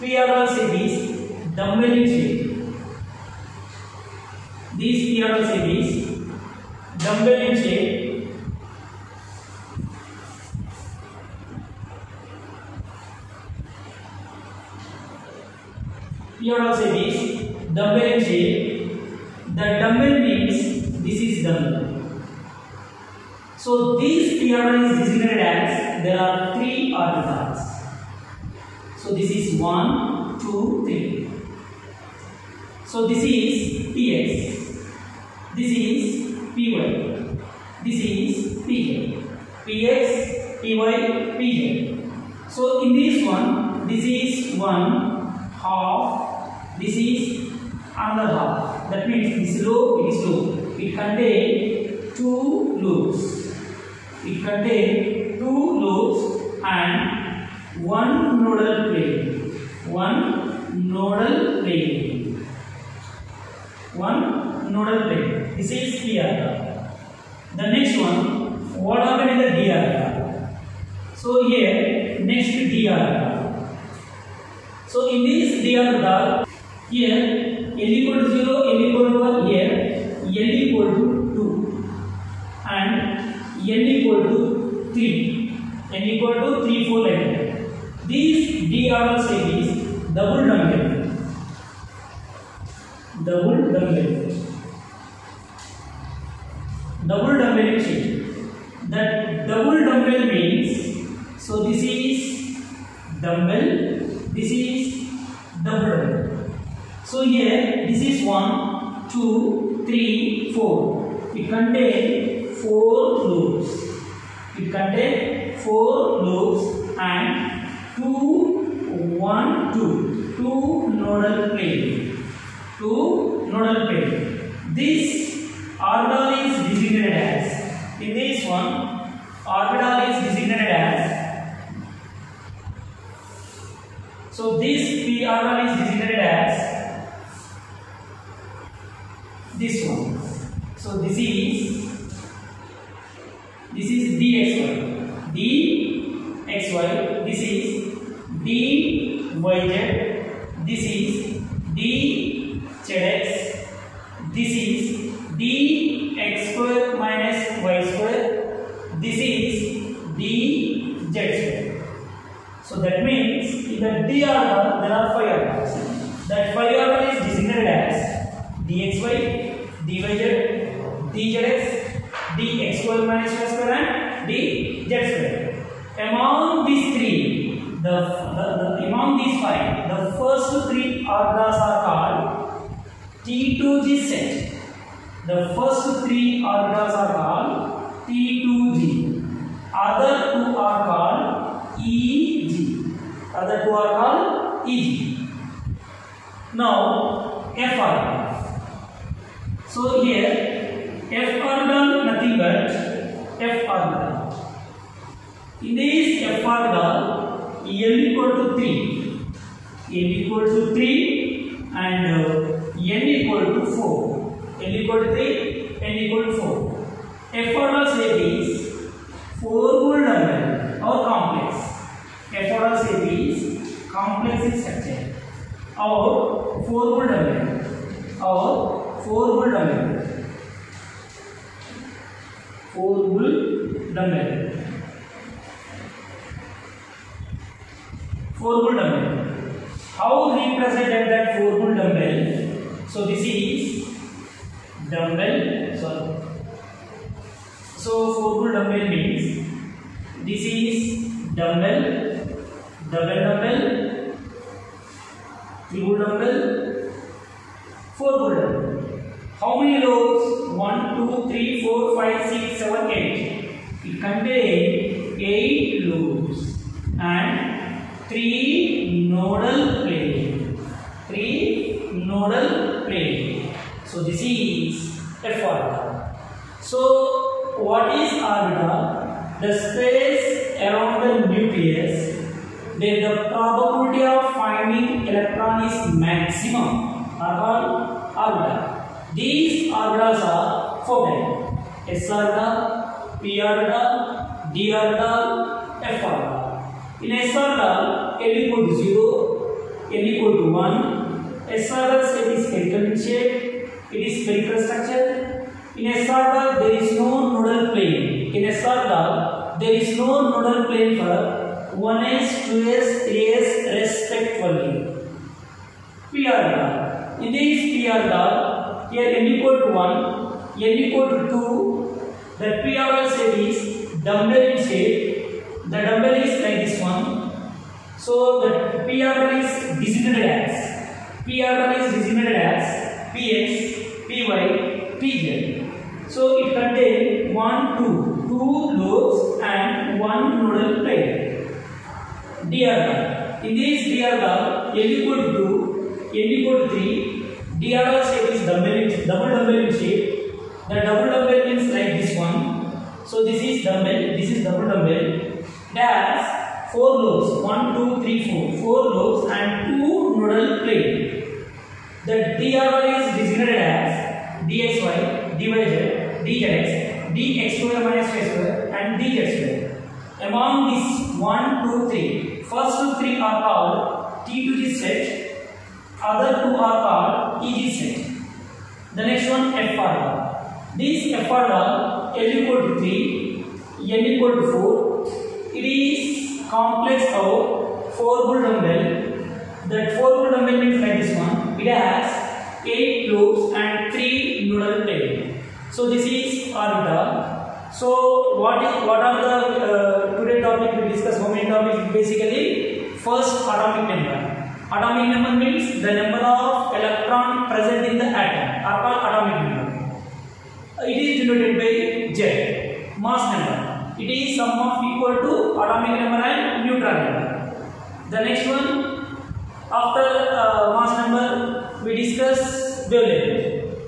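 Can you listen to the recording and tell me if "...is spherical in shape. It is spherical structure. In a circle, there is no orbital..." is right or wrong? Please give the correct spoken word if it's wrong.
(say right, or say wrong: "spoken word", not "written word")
wrong: "nodal", not "orbital".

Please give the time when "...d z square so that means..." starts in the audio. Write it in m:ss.
2:40.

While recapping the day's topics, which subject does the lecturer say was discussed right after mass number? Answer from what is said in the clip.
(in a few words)
Wavelength.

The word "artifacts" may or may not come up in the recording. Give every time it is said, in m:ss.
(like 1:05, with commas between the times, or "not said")
0:26.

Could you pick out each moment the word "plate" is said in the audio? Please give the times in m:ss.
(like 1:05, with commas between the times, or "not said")
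5:40, 6:00.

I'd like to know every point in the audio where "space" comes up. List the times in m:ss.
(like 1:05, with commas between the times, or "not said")
4:39.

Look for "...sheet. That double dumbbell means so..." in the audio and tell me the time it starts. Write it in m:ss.
1:37.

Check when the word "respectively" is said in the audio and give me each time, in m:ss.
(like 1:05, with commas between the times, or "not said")
5:13.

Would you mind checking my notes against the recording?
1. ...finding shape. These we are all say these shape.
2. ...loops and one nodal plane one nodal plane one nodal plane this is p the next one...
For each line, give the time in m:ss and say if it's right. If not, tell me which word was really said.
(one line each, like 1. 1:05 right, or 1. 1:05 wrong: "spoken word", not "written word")
1. 0:01 wrong: "dumbbelling", not "finding"
2. 0:55 right.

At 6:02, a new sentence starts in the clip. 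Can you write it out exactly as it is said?
The DRY is designated as DXY, DYZ, DZX, DX square minus Y square and DZ square.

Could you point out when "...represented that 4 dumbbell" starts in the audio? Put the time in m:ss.
4:00.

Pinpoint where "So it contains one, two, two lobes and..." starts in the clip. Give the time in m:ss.
5:36.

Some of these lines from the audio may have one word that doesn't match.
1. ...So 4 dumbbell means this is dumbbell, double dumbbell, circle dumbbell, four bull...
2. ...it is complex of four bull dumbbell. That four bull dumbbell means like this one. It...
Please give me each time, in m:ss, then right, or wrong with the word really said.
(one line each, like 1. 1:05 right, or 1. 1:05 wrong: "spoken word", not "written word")
1. 4:07 wrong: "triple", not "circle"
2. 6:25 right.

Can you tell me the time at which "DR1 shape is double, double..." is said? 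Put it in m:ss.
5:47.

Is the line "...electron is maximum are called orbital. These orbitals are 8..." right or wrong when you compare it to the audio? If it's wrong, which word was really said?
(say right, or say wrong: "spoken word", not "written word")
wrong: "4", not "8".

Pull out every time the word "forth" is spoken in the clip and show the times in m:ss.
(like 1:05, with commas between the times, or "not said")
not said.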